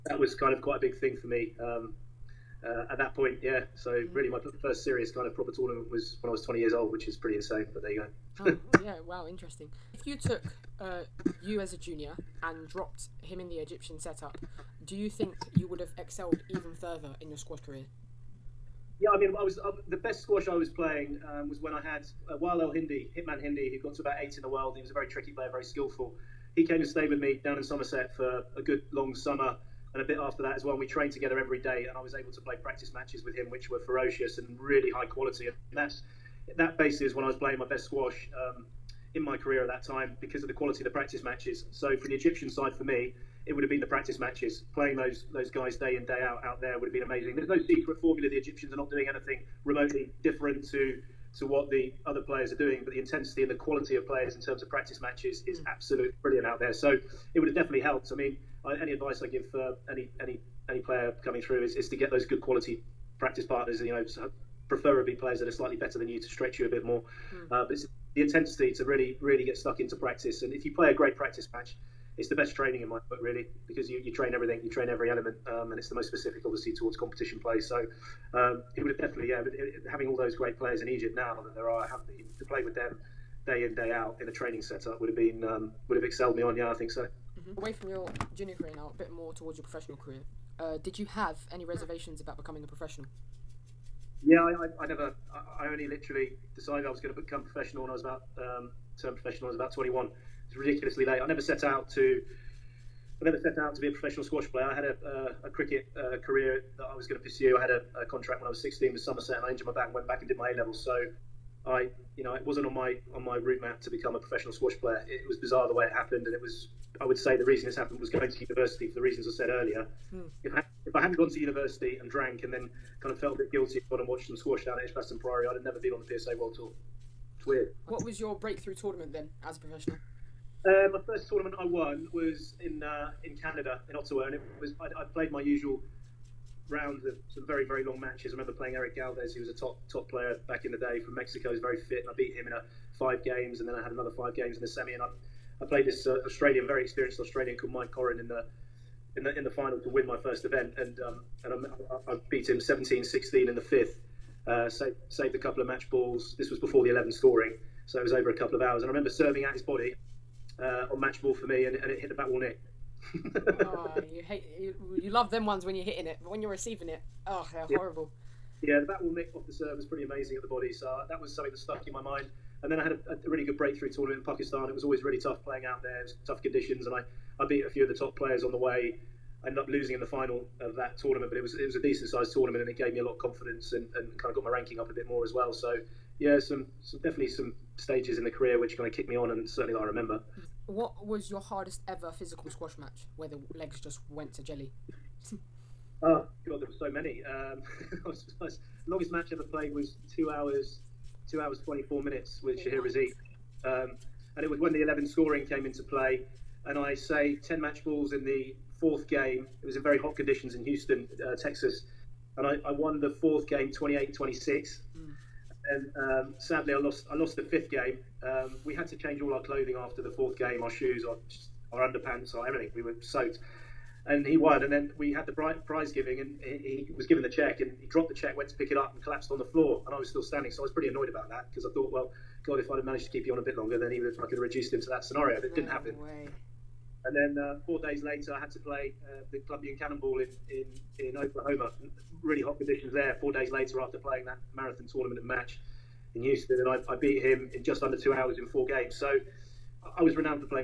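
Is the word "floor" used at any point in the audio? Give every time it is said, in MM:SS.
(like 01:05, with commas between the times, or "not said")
03:49.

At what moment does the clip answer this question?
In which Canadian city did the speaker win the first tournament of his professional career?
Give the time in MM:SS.
02:13.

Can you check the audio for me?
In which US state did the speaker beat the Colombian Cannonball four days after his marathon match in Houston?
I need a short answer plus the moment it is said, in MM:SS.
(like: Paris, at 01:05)
Oklahoma, at 04:01.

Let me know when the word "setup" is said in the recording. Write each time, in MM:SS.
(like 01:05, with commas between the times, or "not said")
00:13, 01:24.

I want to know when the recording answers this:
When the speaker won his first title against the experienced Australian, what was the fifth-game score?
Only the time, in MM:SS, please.
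02:32.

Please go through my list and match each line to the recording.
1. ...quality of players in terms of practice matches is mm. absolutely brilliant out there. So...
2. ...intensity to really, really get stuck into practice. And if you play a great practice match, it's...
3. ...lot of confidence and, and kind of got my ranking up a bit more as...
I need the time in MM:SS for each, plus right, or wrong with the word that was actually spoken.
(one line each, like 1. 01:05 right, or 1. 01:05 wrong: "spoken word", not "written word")
1. 00:53 right
2. 01:08 right
3. 03:03 right.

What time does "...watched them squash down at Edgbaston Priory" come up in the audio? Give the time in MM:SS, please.
02:04.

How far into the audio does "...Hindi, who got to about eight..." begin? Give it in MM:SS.
00:23.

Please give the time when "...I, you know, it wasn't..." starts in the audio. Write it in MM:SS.
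01:51.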